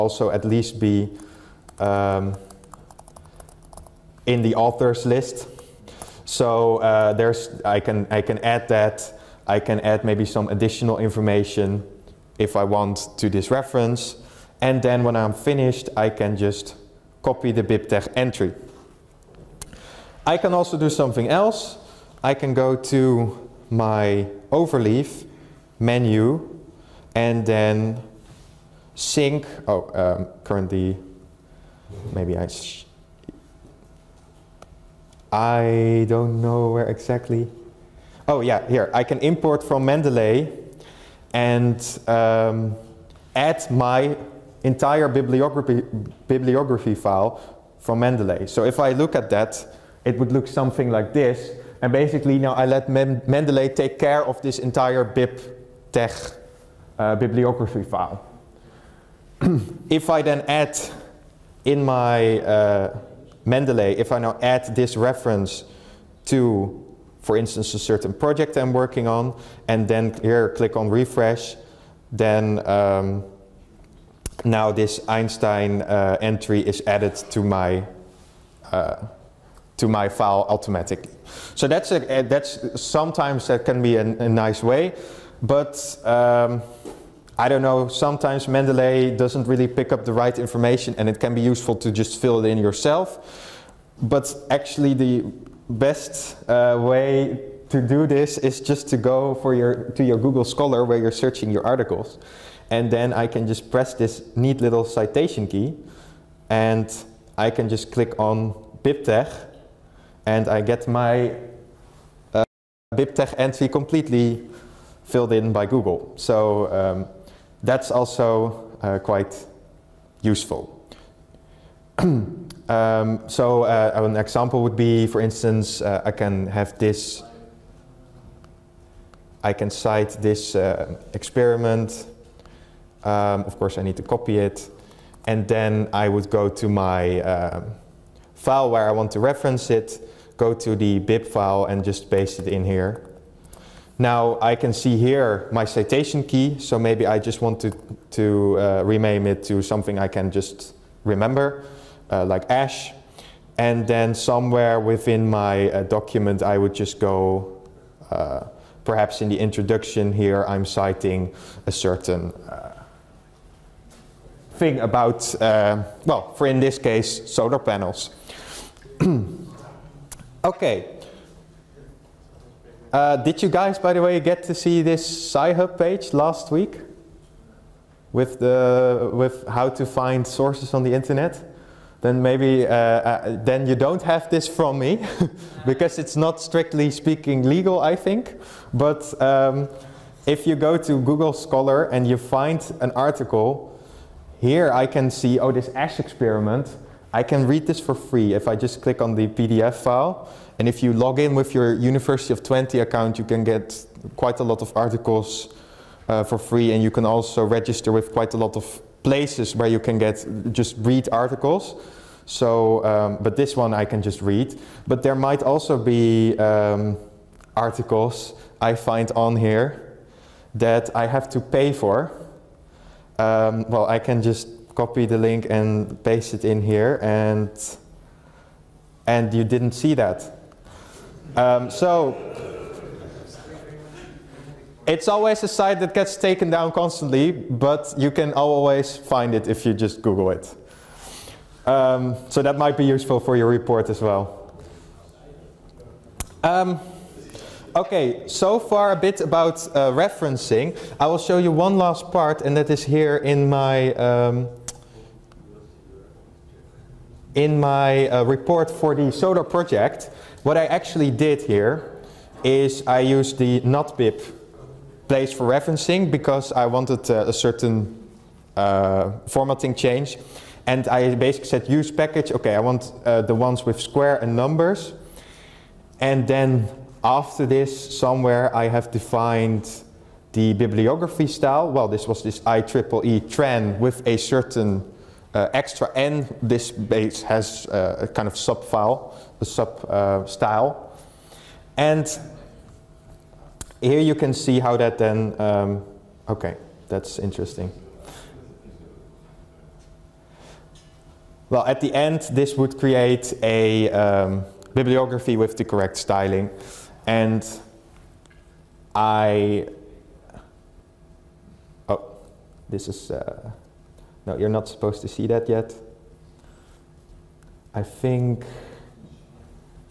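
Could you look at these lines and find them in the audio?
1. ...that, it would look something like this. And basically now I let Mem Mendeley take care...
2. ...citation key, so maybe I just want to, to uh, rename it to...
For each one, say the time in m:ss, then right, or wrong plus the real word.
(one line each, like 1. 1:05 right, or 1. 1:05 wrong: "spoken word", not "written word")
1. 0:49 right
2. 2:25 right.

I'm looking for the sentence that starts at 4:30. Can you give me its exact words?
And I basically said use package, okay, I want uh, the ones with square and numbers.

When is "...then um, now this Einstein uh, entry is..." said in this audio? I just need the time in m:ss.
1:12.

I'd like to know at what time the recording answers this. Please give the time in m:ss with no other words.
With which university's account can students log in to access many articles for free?
3:21.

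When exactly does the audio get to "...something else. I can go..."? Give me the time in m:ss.
0:20.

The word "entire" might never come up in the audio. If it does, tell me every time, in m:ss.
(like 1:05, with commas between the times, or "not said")
0:44, 0:54.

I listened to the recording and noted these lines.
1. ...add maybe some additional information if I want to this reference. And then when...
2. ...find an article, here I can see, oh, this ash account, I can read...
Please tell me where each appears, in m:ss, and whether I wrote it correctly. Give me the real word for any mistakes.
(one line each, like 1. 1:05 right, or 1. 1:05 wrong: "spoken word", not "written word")
1. 0:09 right
2. 3:12 wrong: "experiment", not "account".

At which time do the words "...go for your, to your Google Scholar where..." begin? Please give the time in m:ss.
1:38.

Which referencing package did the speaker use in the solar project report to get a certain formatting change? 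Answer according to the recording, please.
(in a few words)
natbib.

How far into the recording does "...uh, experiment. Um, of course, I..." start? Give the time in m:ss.
2:10.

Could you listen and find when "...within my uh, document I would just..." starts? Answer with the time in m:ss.
2:34.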